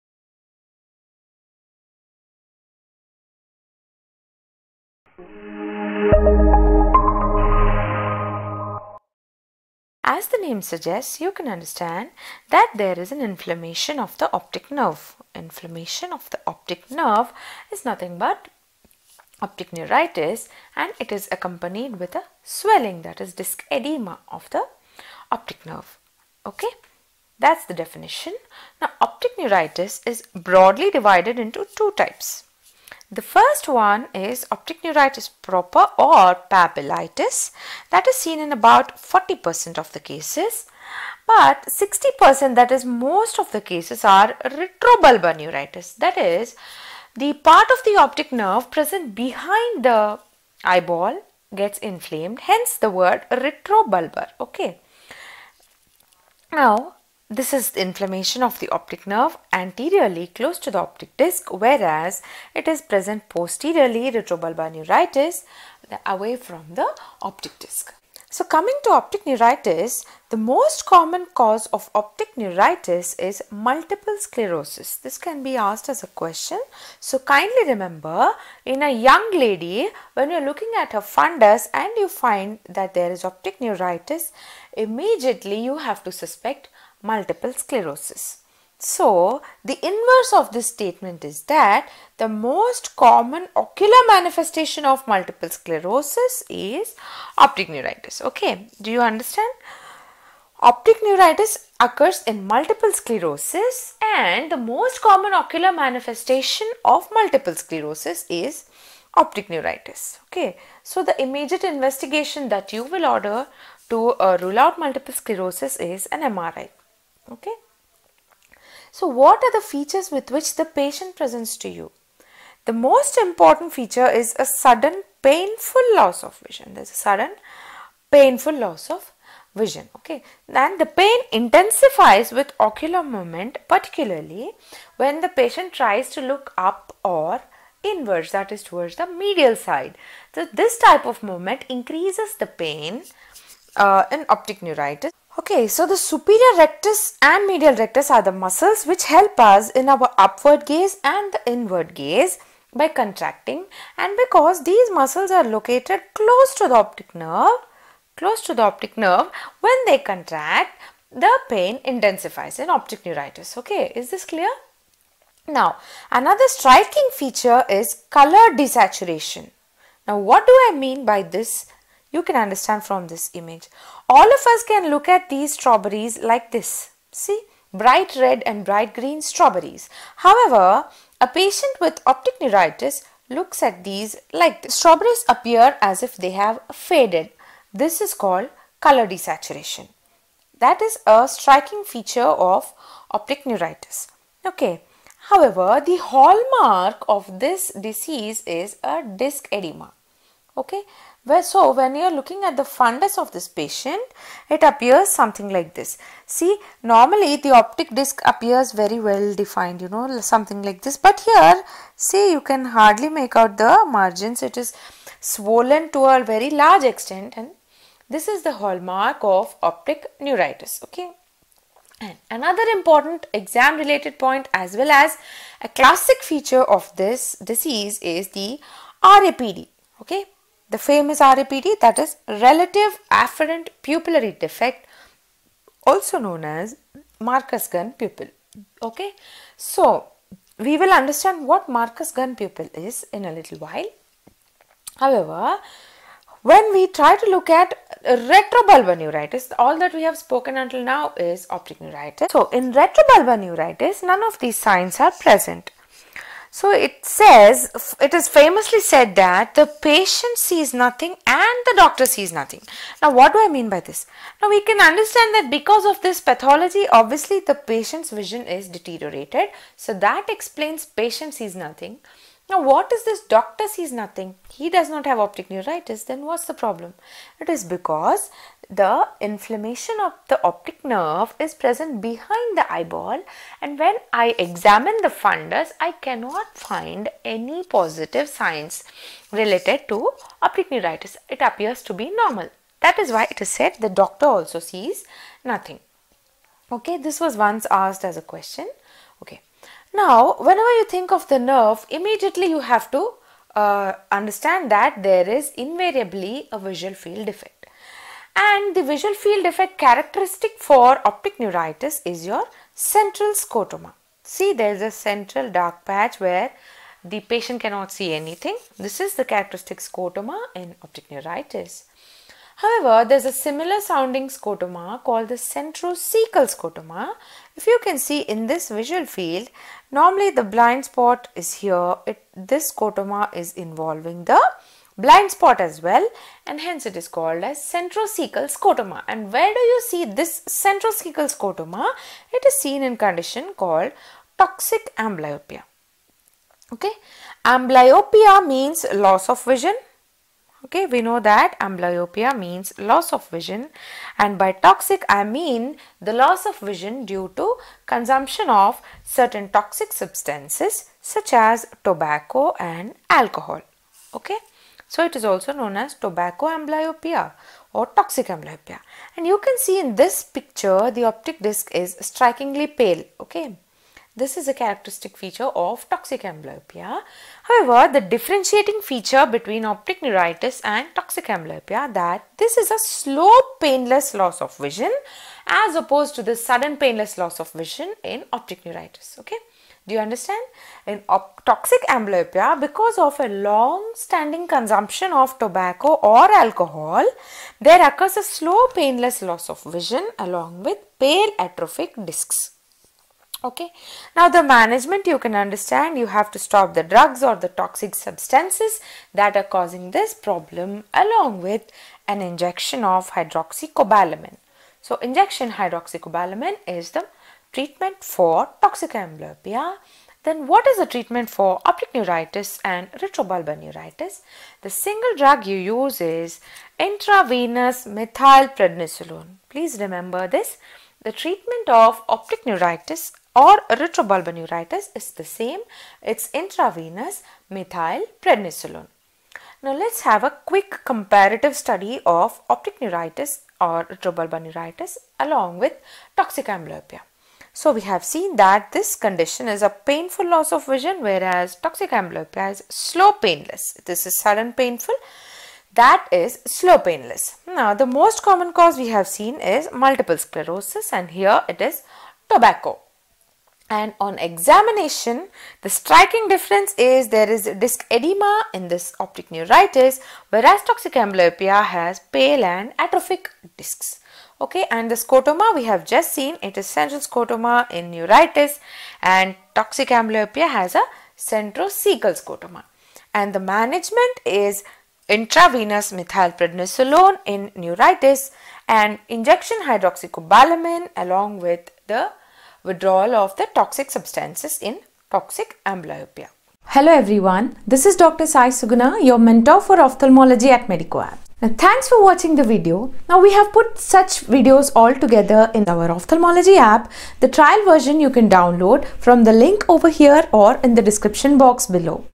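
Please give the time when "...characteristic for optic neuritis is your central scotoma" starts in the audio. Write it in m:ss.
5:09.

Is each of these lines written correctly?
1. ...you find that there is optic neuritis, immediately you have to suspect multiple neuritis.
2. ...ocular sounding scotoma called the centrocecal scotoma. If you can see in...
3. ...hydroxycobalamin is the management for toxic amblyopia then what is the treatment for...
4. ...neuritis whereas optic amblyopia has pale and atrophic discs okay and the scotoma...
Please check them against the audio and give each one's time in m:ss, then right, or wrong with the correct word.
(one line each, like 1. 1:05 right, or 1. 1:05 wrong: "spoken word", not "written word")
1. 1:21 wrong: "sclerosis", not "neuritis"
2. 5:23 wrong: "similar", not "ocular"
3. 6:55 wrong: "treatment", not "management"
4. 7:49 wrong: "toxic", not "optic".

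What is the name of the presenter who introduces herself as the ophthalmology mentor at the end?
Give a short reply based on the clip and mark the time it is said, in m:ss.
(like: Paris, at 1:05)
Dr. Sai Suguna, at 8:17.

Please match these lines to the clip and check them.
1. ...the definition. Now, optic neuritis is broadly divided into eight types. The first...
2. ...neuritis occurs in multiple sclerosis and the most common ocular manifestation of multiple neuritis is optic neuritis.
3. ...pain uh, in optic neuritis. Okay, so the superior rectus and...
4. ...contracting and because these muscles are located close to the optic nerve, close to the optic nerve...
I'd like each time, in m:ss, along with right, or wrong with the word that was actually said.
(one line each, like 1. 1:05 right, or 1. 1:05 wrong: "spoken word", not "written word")
1. 0:27 wrong: "two", not "eight"
2. 1:41 wrong: "sclerosis", not "neuritis"
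3. 2:22 right
4. 2:32 right.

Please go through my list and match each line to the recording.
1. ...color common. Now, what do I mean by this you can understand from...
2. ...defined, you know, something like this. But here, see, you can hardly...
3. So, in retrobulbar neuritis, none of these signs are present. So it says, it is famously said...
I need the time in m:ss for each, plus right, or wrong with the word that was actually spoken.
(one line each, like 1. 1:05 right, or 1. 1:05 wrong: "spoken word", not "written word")
1. 2:48 wrong: "desaturation", not "common"
2. 3:29 right
3. 4:12 right.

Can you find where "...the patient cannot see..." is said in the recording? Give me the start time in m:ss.
5:17.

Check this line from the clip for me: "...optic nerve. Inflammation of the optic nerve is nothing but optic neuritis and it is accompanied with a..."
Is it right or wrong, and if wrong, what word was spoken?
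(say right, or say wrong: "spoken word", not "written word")
right.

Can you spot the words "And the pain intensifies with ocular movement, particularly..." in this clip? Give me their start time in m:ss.
2:10.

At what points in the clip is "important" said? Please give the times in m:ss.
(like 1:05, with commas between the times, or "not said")
2:03, 3:42.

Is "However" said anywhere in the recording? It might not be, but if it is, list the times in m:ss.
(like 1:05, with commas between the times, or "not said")
3:00, 3:15, 4:04, 5:22, 6:17.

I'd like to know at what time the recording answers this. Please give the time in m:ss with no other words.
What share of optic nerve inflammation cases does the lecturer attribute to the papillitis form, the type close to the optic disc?
0:38.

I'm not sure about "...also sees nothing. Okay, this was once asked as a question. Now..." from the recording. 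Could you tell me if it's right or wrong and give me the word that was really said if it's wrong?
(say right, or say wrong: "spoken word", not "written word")
right.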